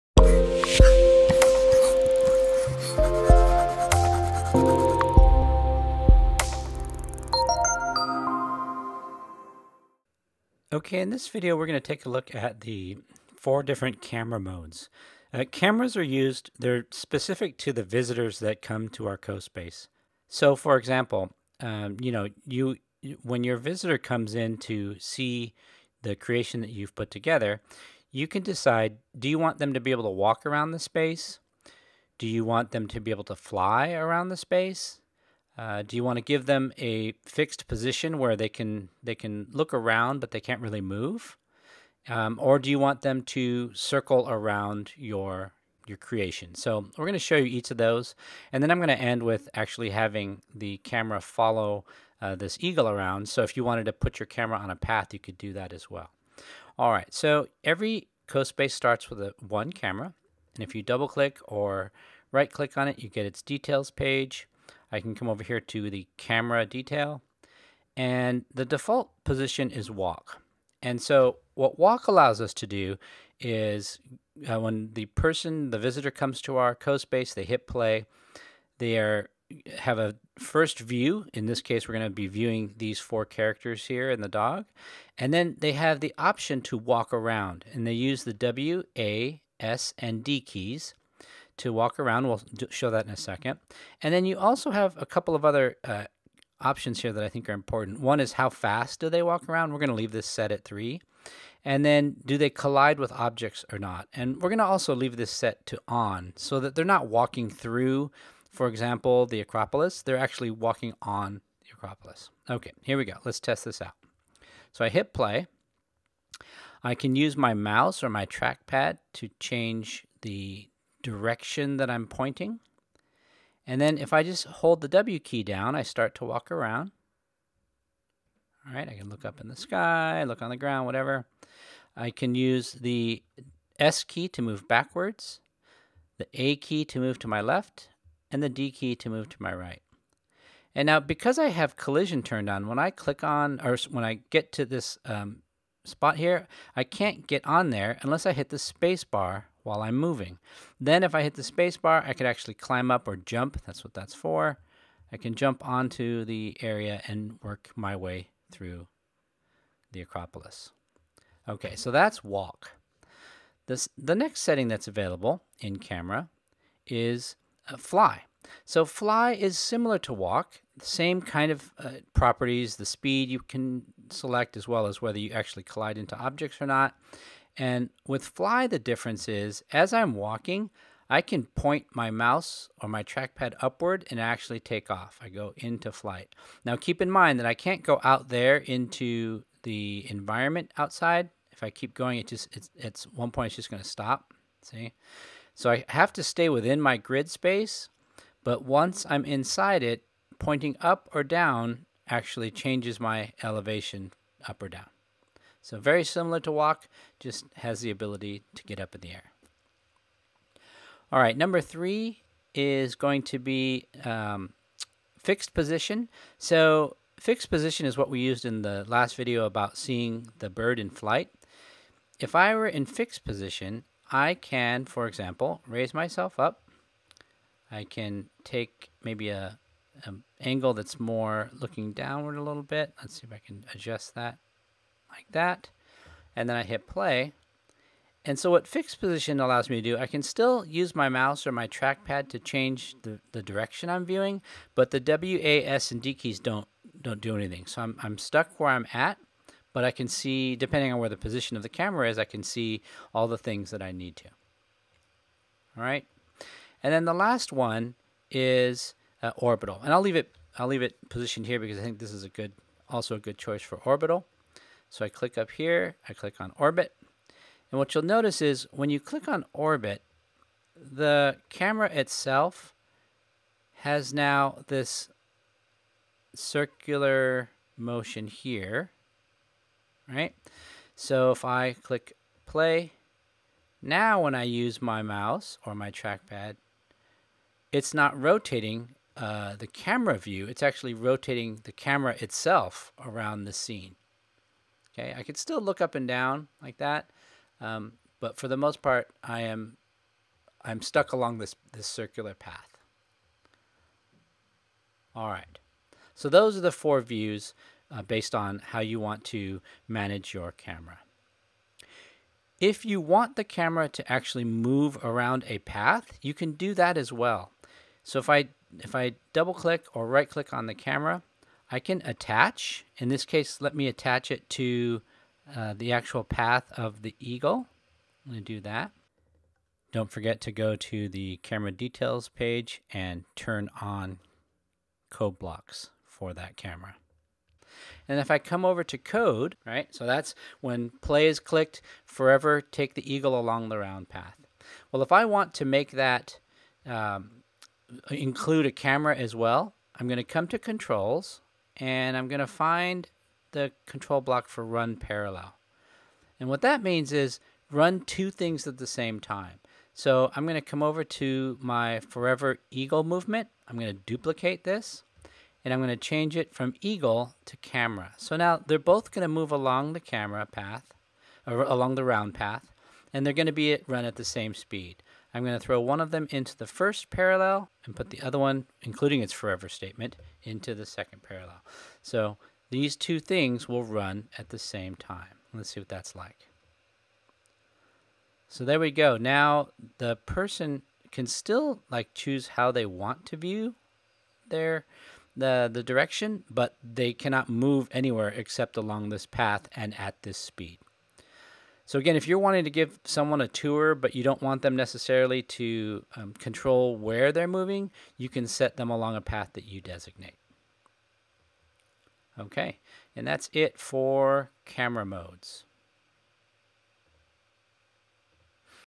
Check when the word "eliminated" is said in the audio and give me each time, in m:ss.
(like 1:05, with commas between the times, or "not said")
not said.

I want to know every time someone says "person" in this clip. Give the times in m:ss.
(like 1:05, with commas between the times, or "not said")
1:15, 6:30.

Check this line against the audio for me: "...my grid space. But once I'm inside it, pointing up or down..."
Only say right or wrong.
right.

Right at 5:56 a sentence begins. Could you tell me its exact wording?
And what that means is run two things at the same time.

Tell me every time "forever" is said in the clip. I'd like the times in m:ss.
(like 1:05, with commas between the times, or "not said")
5:42, 6:01, 6:19.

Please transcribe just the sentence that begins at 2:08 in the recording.
All right, I can look up in the sky, look on the ground, whatever.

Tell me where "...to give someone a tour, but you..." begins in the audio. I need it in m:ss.
6:42.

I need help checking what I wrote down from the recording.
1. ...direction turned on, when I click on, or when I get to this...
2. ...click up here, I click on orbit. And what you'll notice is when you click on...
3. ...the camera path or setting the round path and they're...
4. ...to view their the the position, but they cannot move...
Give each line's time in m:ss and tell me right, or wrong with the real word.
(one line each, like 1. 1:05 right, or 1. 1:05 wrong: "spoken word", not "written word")
1. 2:21 wrong: "collision", not "direction"
2. 4:25 right
3. 6:09 wrong: "along", not "setting"
4. 6:33 wrong: "direction", not "position".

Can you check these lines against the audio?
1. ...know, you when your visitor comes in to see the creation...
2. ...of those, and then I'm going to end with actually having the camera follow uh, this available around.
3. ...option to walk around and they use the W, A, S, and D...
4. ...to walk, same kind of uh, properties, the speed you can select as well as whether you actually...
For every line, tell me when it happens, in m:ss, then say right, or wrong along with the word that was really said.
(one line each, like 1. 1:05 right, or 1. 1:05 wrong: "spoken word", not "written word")
1. 0:22 right
2. 0:47 wrong: "eagle", not "available"
3. 1:26 right
4. 2:49 right.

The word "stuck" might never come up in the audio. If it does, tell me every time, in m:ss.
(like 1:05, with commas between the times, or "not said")
4:08, 5:00.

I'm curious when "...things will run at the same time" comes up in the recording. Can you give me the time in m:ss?
6:23.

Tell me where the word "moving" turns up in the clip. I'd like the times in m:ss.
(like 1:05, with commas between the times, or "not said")
2:29, 6:47.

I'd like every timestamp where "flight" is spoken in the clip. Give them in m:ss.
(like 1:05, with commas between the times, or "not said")
3:05, 3:40.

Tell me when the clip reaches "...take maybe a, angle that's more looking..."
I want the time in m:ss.
3:48.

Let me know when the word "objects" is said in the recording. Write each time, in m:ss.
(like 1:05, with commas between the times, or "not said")
1:43, 2:56.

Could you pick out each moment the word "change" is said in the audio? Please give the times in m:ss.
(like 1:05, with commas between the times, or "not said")
1:59, 3:22, 4:02, 6:05.